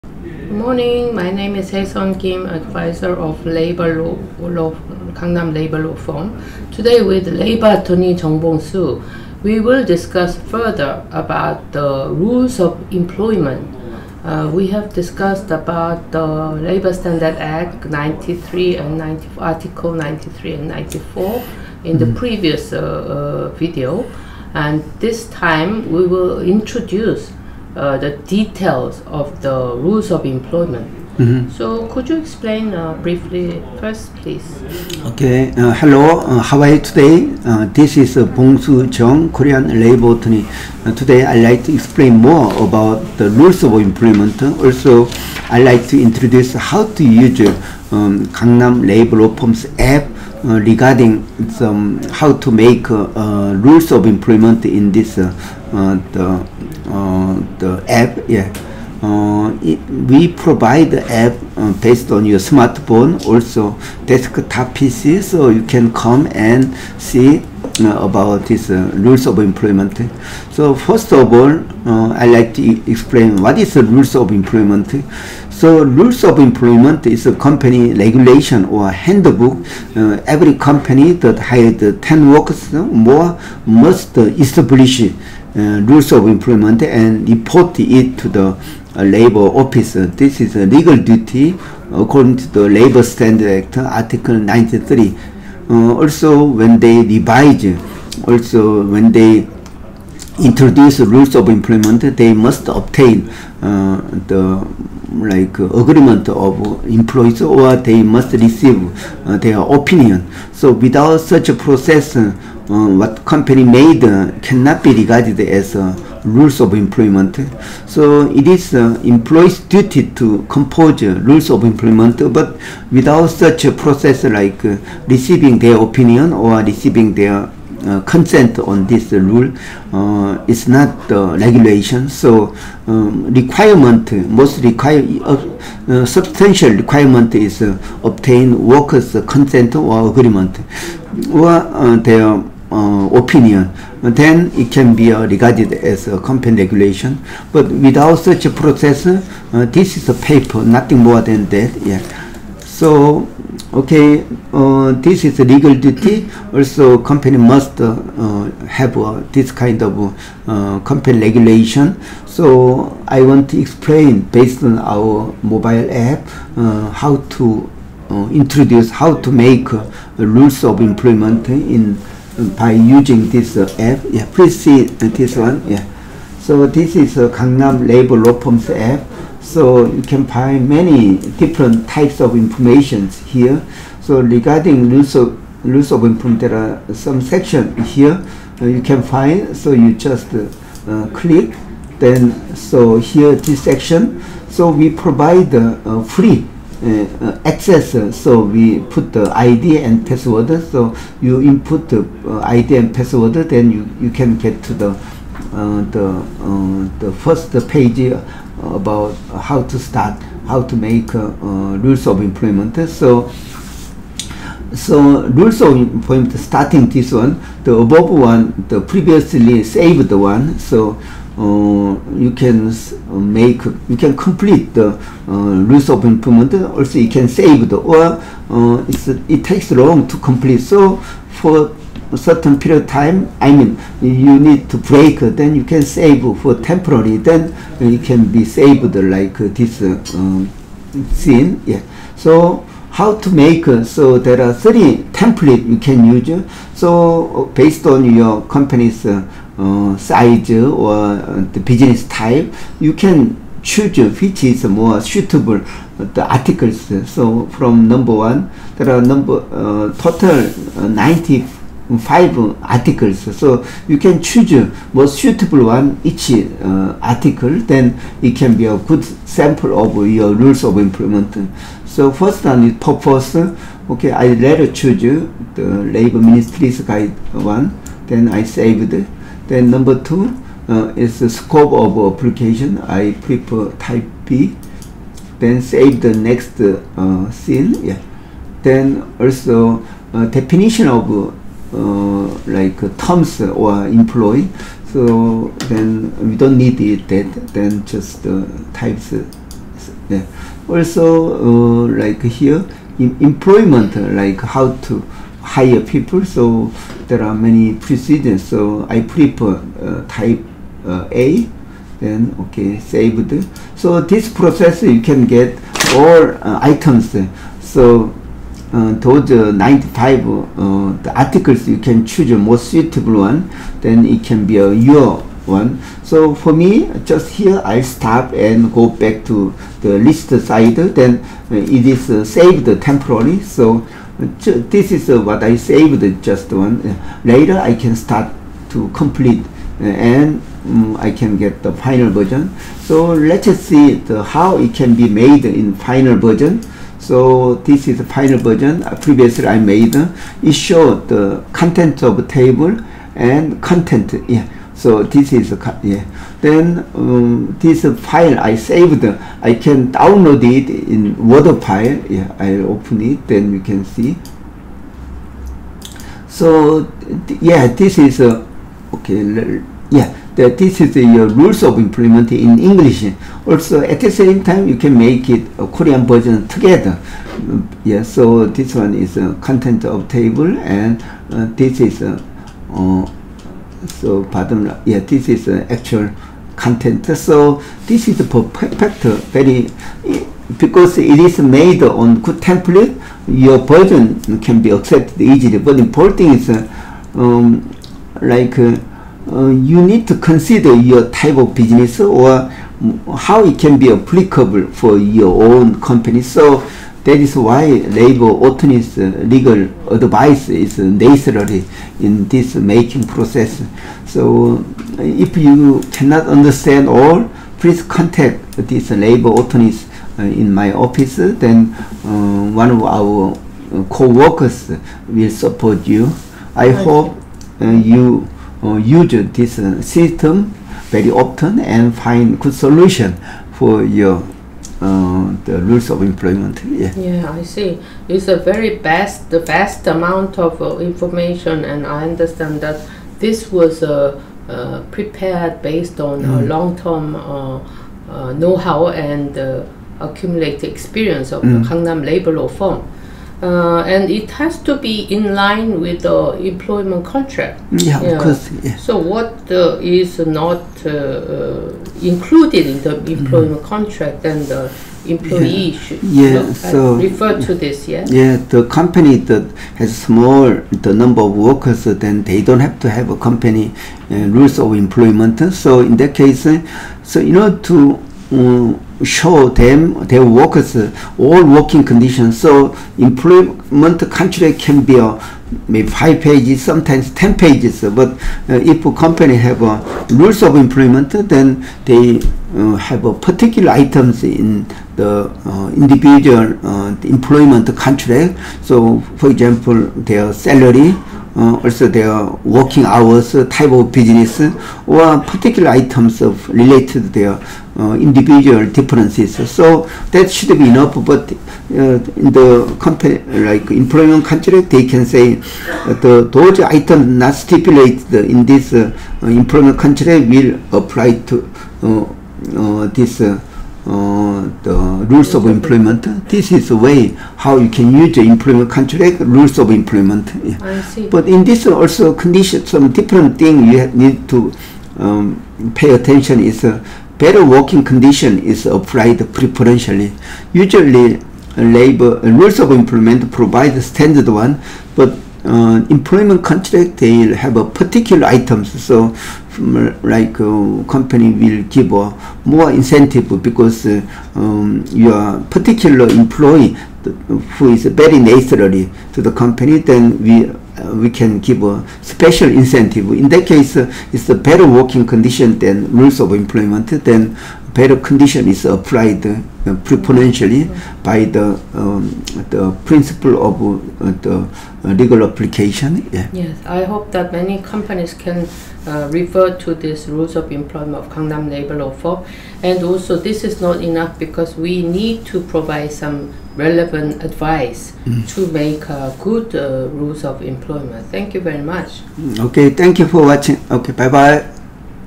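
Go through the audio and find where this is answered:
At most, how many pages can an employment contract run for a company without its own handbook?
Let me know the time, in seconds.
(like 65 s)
487 s.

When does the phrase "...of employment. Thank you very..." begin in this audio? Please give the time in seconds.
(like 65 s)
590 s.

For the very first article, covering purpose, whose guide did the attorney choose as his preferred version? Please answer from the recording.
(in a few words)
Labor ministry.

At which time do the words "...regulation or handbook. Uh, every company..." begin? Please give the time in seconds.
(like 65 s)
77 s.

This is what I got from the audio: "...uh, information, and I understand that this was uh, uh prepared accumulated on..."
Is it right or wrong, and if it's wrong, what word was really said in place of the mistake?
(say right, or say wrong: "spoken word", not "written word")
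wrong: "based", not "accumulated".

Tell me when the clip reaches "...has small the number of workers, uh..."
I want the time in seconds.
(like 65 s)
469 s.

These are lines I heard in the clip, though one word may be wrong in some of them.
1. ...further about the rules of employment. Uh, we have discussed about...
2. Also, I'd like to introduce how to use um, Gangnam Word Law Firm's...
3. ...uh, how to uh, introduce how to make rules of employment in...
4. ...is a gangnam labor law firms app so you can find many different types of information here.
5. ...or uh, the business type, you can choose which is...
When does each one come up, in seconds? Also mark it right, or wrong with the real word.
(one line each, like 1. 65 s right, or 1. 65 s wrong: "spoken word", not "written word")
1. 10 s right
2. 44 s wrong: "Labor", not "Word"
3. 166 s right
4. 176 s right
5. 250 s right.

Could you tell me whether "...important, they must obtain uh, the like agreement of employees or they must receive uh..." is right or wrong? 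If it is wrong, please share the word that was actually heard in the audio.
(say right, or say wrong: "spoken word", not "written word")
wrong: "employment", not "important".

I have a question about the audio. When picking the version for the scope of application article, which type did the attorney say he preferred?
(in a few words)
Type B.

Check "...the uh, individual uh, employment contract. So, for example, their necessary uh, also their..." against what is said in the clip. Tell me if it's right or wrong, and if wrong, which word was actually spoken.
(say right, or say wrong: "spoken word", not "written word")
wrong: "salary", not "necessary".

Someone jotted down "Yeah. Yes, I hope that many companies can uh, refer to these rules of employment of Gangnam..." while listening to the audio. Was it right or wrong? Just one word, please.
right.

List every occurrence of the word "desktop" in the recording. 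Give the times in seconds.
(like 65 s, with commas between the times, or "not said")
64 s.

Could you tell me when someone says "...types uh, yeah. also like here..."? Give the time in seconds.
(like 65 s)
298 s.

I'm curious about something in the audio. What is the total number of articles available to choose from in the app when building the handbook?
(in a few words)
95.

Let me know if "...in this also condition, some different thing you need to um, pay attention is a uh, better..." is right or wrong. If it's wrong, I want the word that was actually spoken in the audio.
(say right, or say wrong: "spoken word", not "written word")
right.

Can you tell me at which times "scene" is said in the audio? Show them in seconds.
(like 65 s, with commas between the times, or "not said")
241 s, 287 s.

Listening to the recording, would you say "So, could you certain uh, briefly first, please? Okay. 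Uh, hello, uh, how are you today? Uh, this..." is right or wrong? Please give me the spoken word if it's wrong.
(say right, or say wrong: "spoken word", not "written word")
wrong: "explain", not "certain".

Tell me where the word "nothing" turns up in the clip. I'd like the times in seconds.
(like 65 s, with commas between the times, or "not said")
150 s.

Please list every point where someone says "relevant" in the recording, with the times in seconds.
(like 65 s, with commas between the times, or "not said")
586 s.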